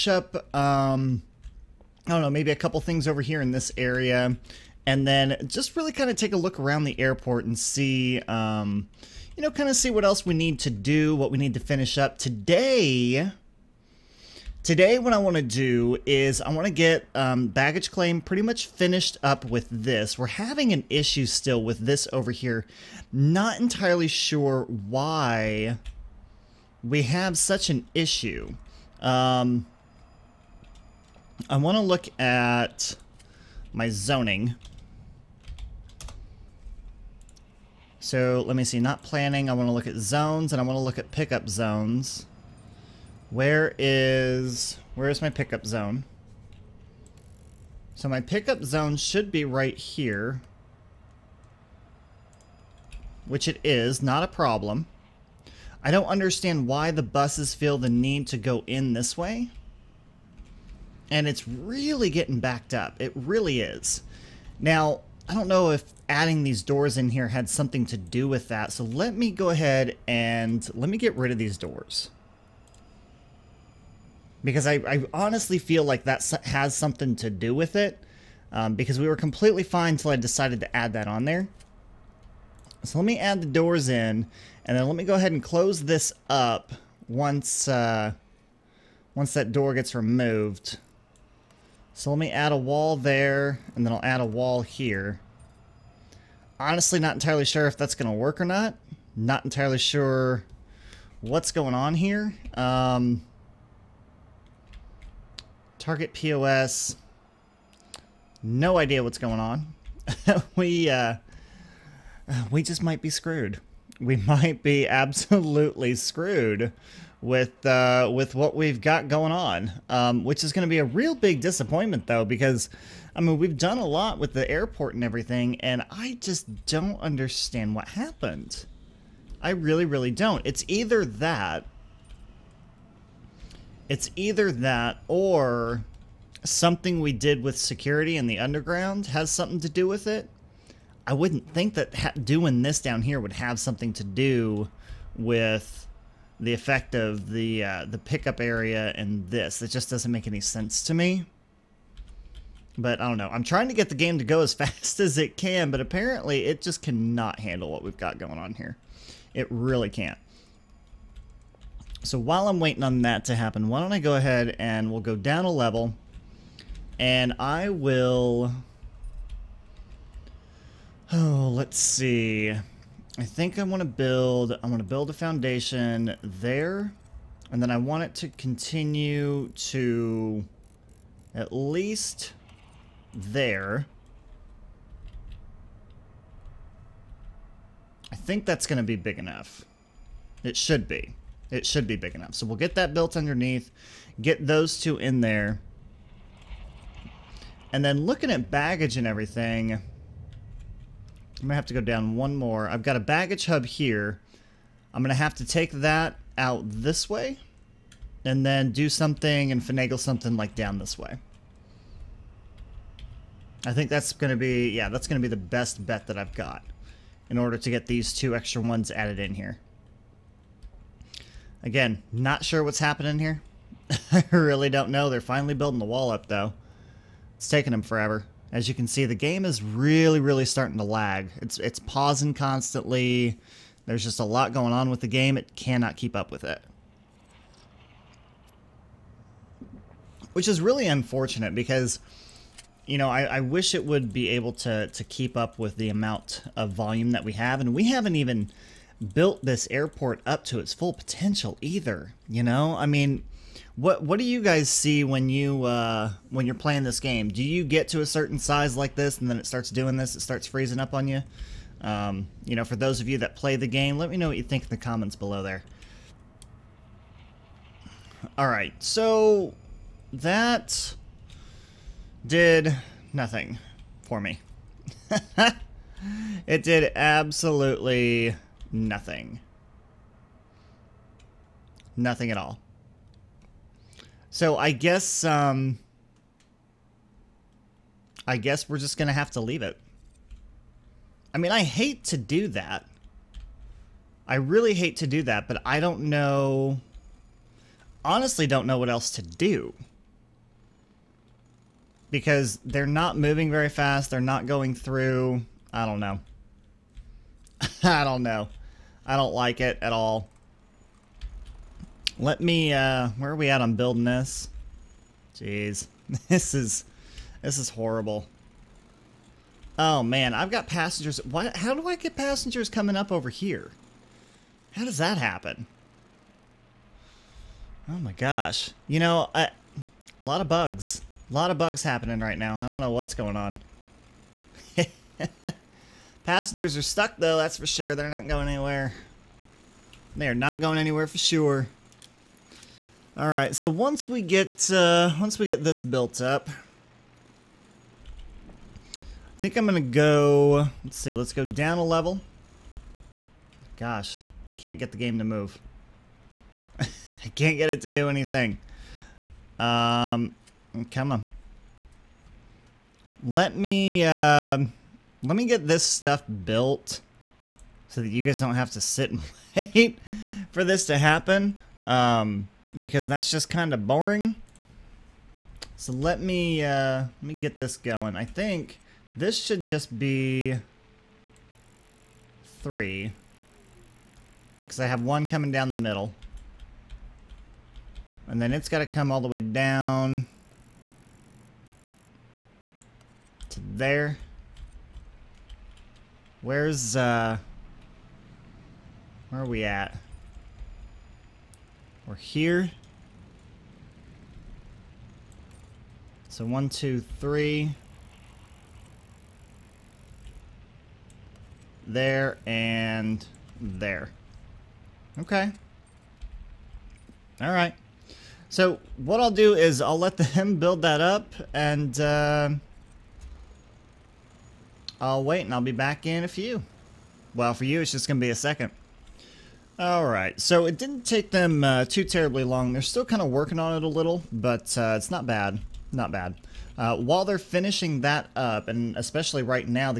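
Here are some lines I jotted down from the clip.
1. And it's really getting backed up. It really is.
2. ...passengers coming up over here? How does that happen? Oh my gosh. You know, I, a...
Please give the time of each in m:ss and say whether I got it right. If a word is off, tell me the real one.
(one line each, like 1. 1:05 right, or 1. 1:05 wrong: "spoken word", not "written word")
1. 1:01 right
2. 5:22 right.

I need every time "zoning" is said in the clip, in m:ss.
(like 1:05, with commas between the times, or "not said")
0:33.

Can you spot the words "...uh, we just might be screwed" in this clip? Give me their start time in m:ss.
1:50.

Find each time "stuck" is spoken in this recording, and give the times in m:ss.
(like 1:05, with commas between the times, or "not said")
5:36.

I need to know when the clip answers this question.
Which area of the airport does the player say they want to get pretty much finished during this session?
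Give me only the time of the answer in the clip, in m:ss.
0:17.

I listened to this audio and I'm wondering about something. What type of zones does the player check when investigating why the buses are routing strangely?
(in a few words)
Pickup zones.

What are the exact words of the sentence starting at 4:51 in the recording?
I mean, I hate to do that.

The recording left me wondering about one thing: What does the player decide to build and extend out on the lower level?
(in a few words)
A foundation.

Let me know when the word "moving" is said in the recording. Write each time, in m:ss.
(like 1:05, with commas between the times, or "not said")
5:03.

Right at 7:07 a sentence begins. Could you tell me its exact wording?
Well, for you, it's just going to be a second.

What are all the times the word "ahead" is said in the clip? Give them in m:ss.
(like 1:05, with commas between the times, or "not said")
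1:09, 1:25, 2:44.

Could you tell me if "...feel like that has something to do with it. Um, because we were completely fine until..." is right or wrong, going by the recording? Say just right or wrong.
right.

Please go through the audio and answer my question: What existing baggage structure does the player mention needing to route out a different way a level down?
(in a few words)
Baggage hub.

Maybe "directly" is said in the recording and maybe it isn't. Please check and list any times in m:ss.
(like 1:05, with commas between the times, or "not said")
not said.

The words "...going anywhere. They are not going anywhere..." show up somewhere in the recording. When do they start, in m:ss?
5:38.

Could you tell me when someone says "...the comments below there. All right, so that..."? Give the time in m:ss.
4:24.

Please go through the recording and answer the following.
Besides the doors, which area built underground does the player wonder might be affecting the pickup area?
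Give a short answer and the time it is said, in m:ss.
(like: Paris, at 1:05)
Security, at 2:17.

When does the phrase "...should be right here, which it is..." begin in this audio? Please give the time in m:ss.
0:48.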